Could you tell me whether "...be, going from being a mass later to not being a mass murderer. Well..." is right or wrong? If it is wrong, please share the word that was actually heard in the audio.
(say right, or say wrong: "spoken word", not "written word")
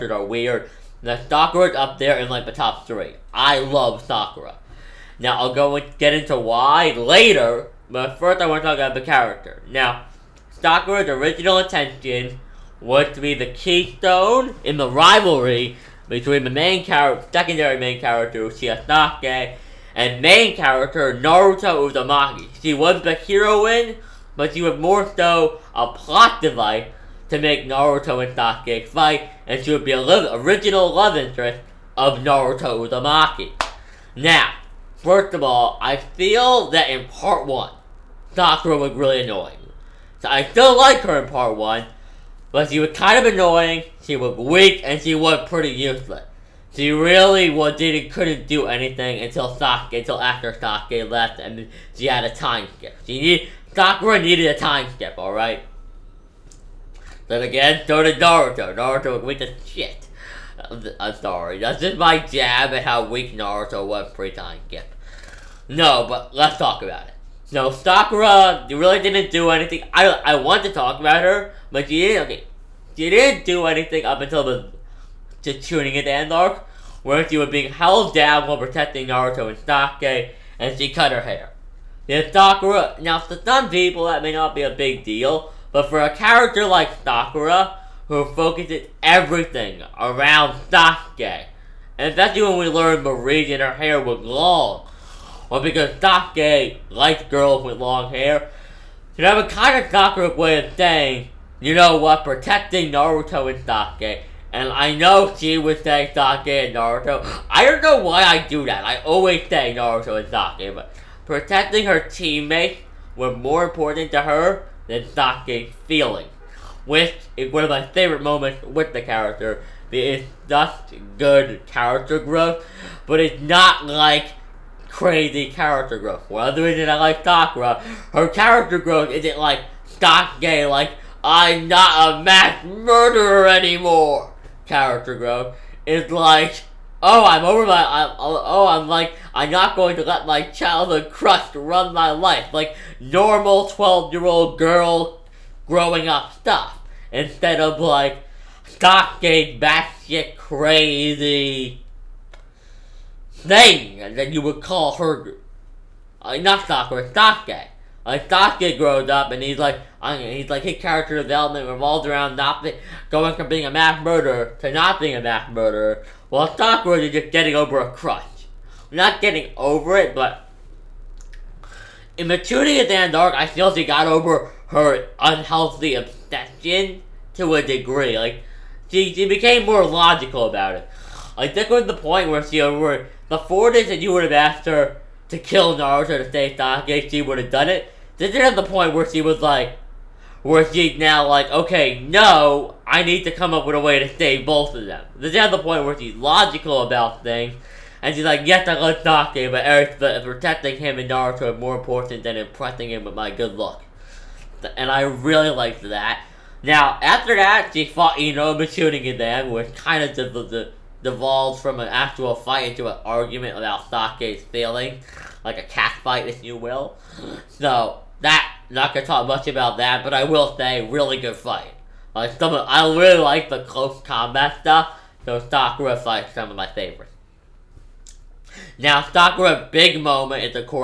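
wrong: "murderer", not "later".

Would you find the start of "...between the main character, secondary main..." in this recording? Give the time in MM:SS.
00:16.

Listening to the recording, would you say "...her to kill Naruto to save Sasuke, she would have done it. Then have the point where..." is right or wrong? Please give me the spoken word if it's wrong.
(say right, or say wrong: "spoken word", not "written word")
right.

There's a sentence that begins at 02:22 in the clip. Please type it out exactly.
Like normal 12 year old girl growing up stuff.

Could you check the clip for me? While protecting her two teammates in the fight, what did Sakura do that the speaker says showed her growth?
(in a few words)
cut her hair.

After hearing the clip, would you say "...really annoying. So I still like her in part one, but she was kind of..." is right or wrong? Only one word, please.
right.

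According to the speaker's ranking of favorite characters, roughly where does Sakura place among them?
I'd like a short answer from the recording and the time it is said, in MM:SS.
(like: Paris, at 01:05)
top three, at 00:02.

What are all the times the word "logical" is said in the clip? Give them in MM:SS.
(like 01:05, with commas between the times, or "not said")
02:59, 03:16.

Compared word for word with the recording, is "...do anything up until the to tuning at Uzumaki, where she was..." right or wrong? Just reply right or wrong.
wrong.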